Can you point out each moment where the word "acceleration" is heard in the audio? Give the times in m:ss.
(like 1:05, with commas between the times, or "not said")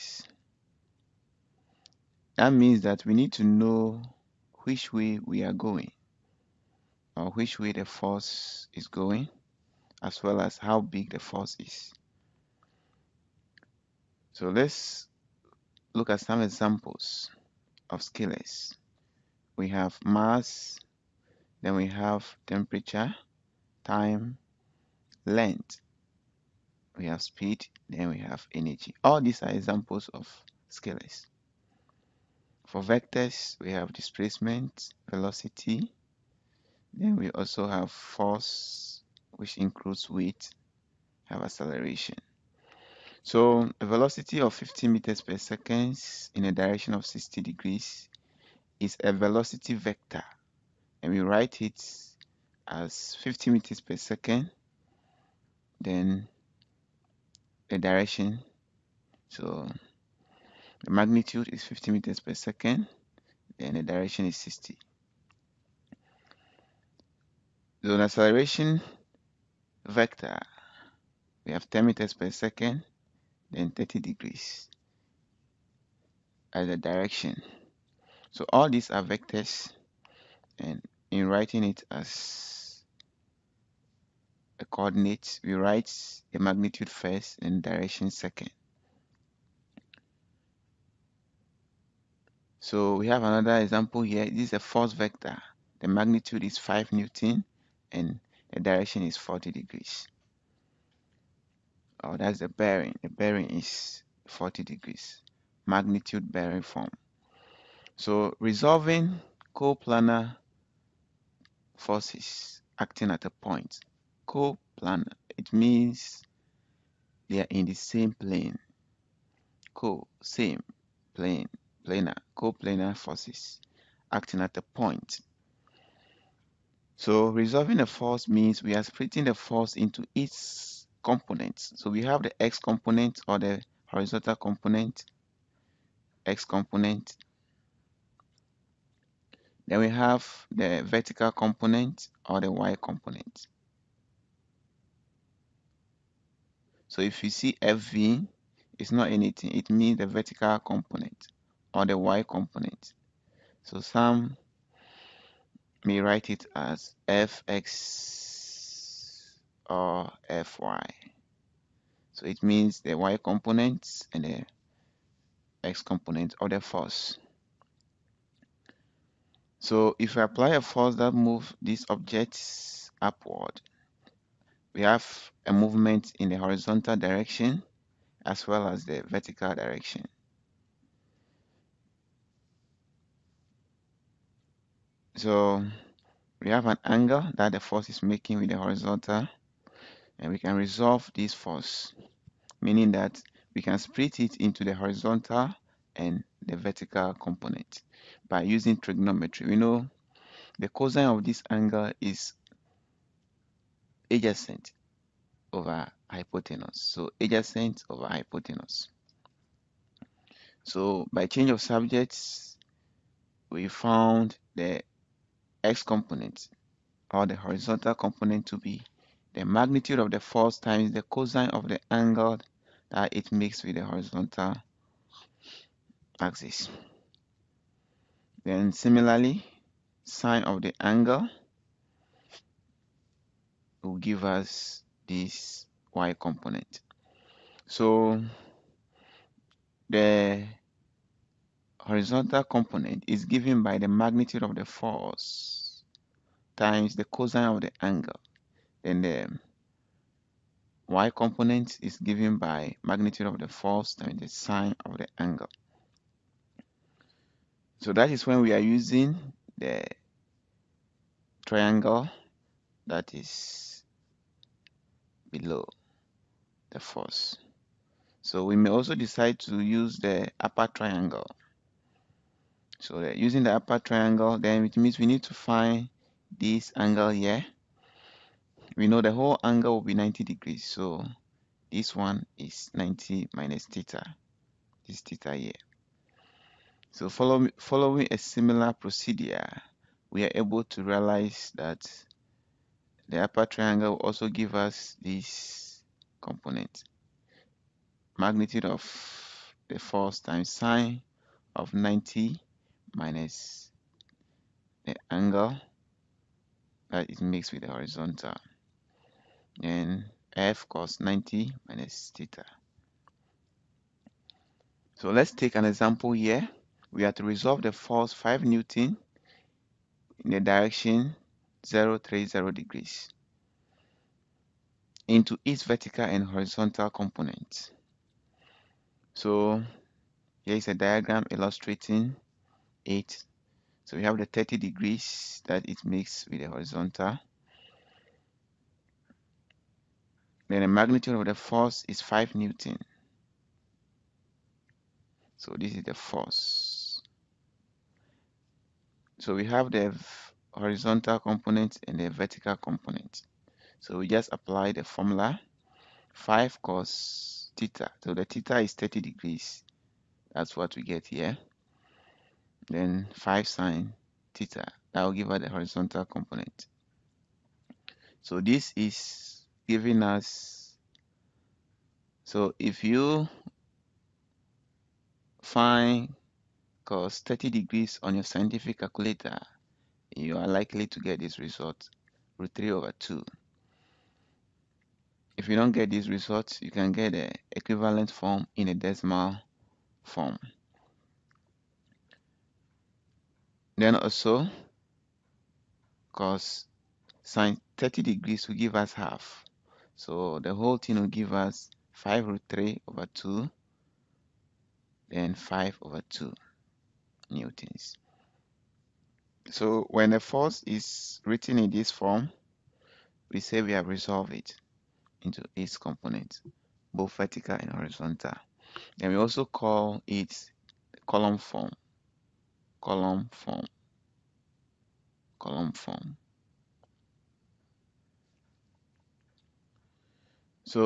0:41, 1:08.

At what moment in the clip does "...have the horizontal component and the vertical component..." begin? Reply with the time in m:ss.
5:49.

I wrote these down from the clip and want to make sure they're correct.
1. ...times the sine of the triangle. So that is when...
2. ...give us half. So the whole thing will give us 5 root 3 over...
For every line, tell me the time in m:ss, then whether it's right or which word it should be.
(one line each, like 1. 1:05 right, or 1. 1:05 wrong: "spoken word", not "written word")
1. 4:13 wrong: "angle", not "triangle"
2. 6:38 right.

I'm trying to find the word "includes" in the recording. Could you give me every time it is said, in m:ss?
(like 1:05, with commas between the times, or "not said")
0:39.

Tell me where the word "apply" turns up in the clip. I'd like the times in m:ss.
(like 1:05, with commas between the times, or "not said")
2:50, 5:54.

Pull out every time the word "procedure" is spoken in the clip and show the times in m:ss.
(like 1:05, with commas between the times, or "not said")
4:48.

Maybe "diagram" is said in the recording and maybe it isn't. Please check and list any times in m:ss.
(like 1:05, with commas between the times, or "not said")
5:30.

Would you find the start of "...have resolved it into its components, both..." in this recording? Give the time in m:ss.
6:53.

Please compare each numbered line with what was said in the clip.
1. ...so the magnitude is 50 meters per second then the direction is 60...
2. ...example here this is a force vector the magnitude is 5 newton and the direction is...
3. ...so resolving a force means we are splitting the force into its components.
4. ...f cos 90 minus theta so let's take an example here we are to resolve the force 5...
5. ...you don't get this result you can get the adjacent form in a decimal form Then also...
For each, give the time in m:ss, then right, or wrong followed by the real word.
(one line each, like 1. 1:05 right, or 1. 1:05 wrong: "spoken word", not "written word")
1. 0:59 right
2. 1:33 right
3. 2:07 right
4. 5:10 right
5. 6:25 wrong: "equivalent", not "adjacent".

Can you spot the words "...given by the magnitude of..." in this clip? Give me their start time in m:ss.
4:03.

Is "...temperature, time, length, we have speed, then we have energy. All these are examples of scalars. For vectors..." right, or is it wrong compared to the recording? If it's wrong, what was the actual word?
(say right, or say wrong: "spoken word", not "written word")
right.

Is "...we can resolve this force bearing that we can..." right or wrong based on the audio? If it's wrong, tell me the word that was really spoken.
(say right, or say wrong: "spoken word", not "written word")
wrong: "meaning", not "bearing".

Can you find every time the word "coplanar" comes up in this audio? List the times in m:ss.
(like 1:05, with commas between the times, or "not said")
1:49, 1:54, 2:02.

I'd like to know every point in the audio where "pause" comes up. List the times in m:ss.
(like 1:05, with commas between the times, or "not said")
not said.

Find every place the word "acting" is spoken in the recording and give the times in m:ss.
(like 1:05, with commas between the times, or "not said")
1:52, 2:04.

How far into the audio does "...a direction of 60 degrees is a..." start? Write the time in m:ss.
0:46.